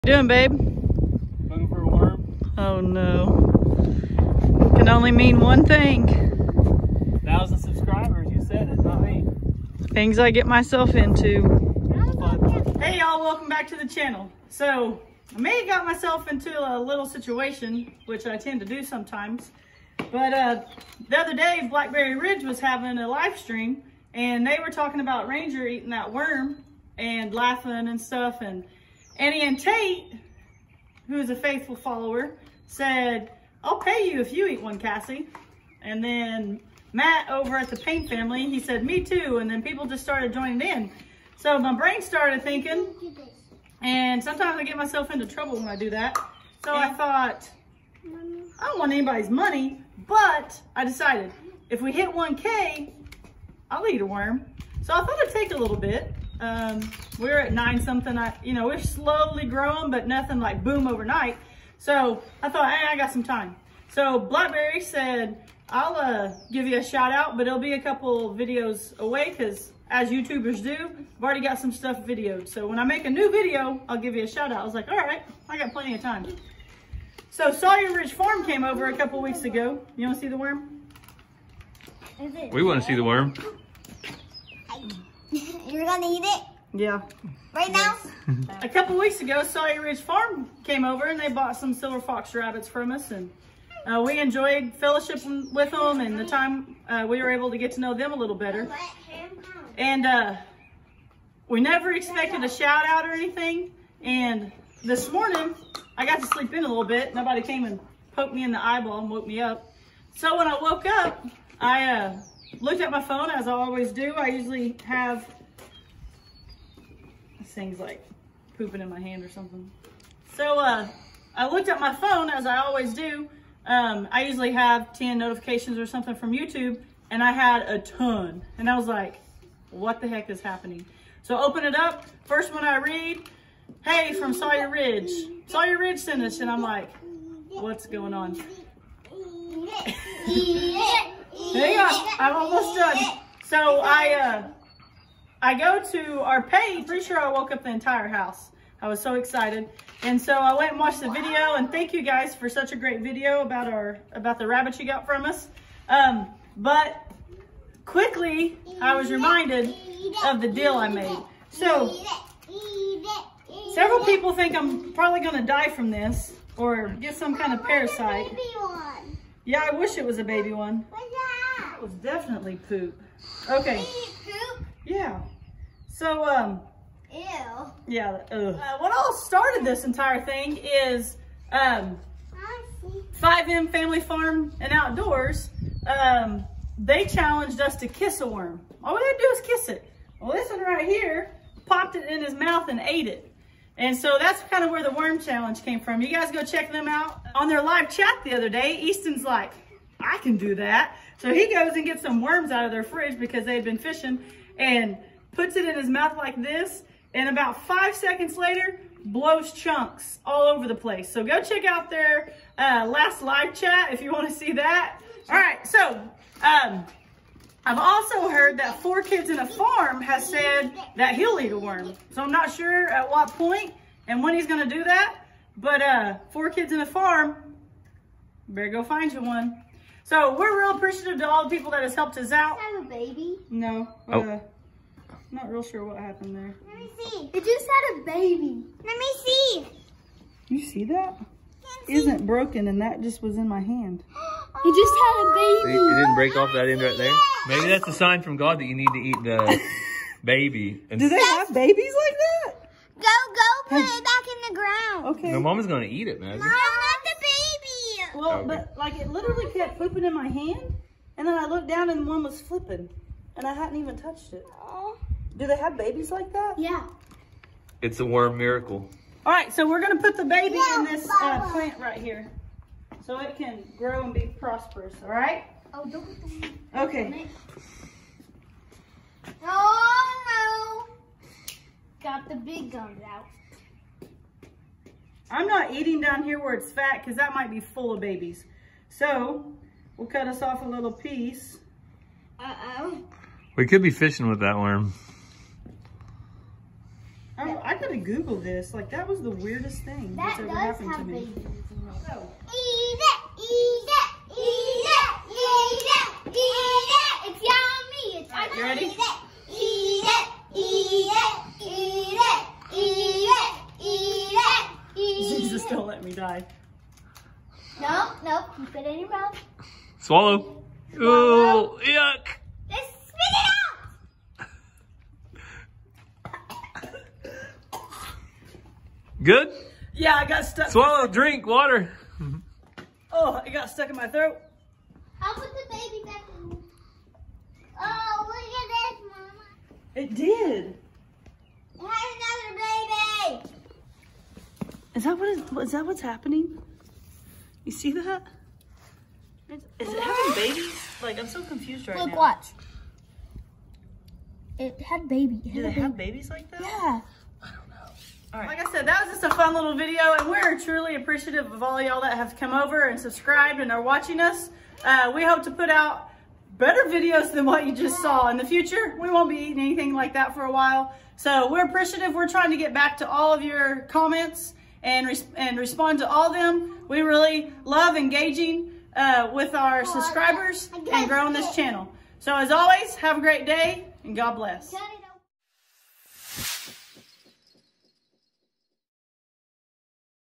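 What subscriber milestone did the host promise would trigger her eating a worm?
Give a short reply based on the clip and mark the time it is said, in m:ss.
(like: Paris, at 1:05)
1K, at 0:52.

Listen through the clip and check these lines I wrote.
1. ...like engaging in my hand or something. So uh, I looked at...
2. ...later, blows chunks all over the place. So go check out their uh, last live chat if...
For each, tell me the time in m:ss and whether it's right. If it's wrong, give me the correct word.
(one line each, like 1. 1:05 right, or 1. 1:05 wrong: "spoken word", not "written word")
1. 1:57 wrong: "pooping", not "engaging"
2. 3:28 right.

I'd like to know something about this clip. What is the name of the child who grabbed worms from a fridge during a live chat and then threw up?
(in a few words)
Easton.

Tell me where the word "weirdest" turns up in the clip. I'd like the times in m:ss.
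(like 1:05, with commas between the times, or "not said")
4:59.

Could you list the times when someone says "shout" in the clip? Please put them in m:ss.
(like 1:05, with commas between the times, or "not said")
1:06, 1:14, 1:42.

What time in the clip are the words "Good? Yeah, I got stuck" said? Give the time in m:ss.
5:29.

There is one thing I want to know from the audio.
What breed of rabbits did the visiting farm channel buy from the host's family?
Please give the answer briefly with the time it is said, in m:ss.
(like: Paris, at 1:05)
silver fox, at 1:31.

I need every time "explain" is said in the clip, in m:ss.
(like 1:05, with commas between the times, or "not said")
not said.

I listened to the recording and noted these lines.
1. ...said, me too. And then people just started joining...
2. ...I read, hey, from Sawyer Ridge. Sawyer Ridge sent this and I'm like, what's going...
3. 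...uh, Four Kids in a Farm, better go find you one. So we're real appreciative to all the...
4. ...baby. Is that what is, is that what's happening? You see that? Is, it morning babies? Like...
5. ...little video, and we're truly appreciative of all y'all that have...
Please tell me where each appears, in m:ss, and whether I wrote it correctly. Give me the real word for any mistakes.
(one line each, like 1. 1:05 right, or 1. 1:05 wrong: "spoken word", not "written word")
1. 0:38 right
2. 2:12 right
3. 3:45 right
4. 5:43 wrong: "having", not "morning"
5. 5:59 right.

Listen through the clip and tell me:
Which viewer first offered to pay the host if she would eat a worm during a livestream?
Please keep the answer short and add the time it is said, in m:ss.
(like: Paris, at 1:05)
Ann Tate, at 0:29.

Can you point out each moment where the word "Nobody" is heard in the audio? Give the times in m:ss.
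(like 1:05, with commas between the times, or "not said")
1:47.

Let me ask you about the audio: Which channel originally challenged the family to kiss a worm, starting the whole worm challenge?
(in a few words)
5M Family Farm and Outdoors.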